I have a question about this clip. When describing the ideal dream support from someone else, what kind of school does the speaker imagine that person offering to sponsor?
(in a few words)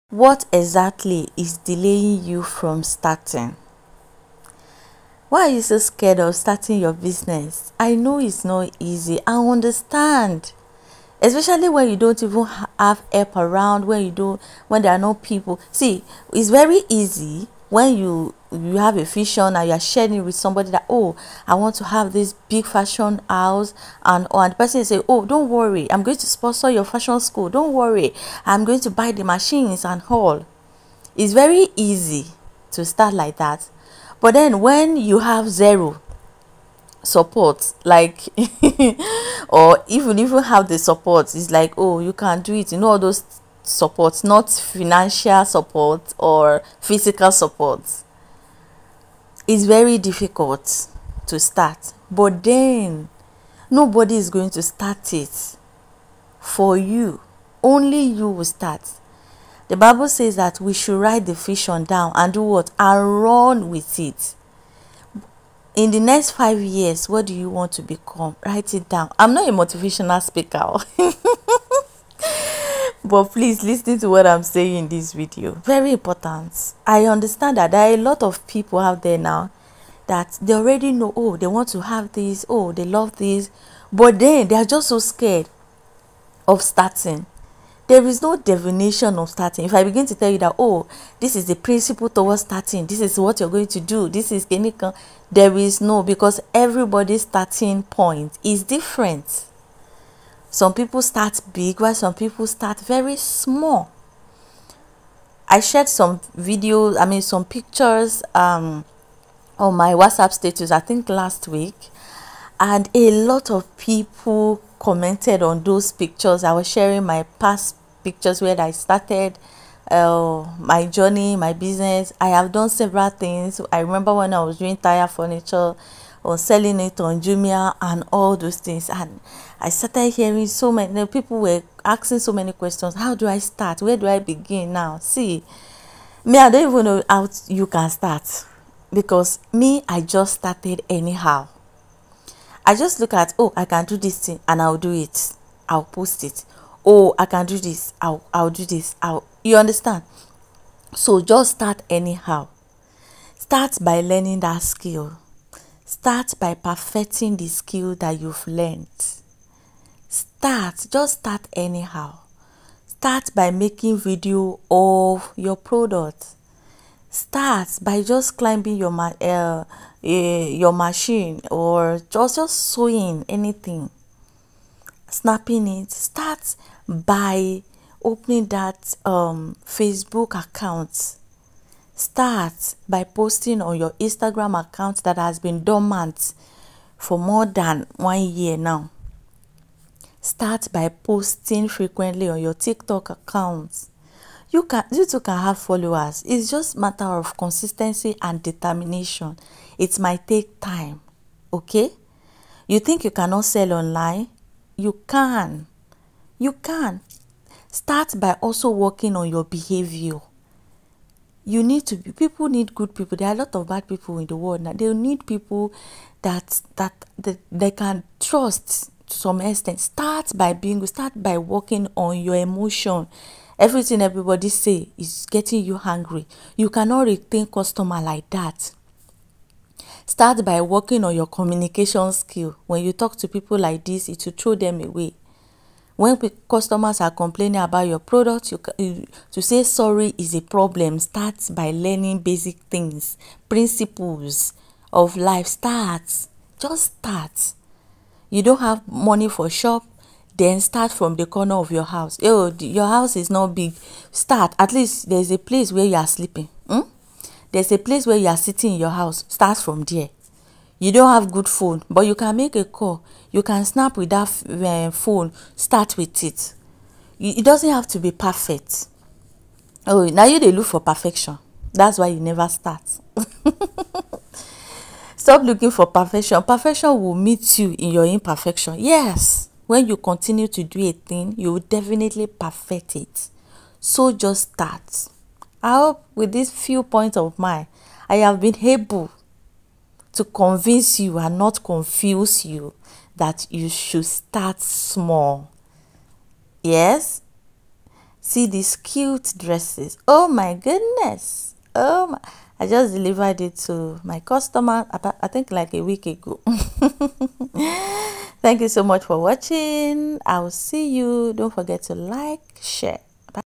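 fashion school.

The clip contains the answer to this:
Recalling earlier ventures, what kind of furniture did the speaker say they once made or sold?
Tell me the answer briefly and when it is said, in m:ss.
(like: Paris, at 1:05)
tire furniture, at 2:04.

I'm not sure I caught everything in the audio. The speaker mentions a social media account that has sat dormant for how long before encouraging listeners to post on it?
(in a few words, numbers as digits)
more than 1 year.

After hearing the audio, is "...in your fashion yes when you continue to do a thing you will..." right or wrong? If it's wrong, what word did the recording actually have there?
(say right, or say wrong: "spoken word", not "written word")
wrong: "imperfection", not "fashion".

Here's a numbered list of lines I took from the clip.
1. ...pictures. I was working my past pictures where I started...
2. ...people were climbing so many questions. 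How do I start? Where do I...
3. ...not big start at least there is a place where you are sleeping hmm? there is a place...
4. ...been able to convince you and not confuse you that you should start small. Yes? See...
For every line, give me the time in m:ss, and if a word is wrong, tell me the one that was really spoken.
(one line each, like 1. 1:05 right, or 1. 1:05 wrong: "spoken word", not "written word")
1. 1:55 wrong: "sharing", not "working"
2. 2:11 wrong: "asking", not "climbing"
3. 4:13 right
4. 4:48 right.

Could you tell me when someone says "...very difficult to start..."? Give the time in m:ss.
0:49.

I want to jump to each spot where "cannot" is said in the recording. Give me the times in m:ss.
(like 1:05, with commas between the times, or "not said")
3:23, 3:46.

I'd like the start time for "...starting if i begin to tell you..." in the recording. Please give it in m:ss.
1:29.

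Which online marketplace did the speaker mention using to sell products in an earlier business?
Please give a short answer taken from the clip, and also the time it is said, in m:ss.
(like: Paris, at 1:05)
Jumia, at 2:07.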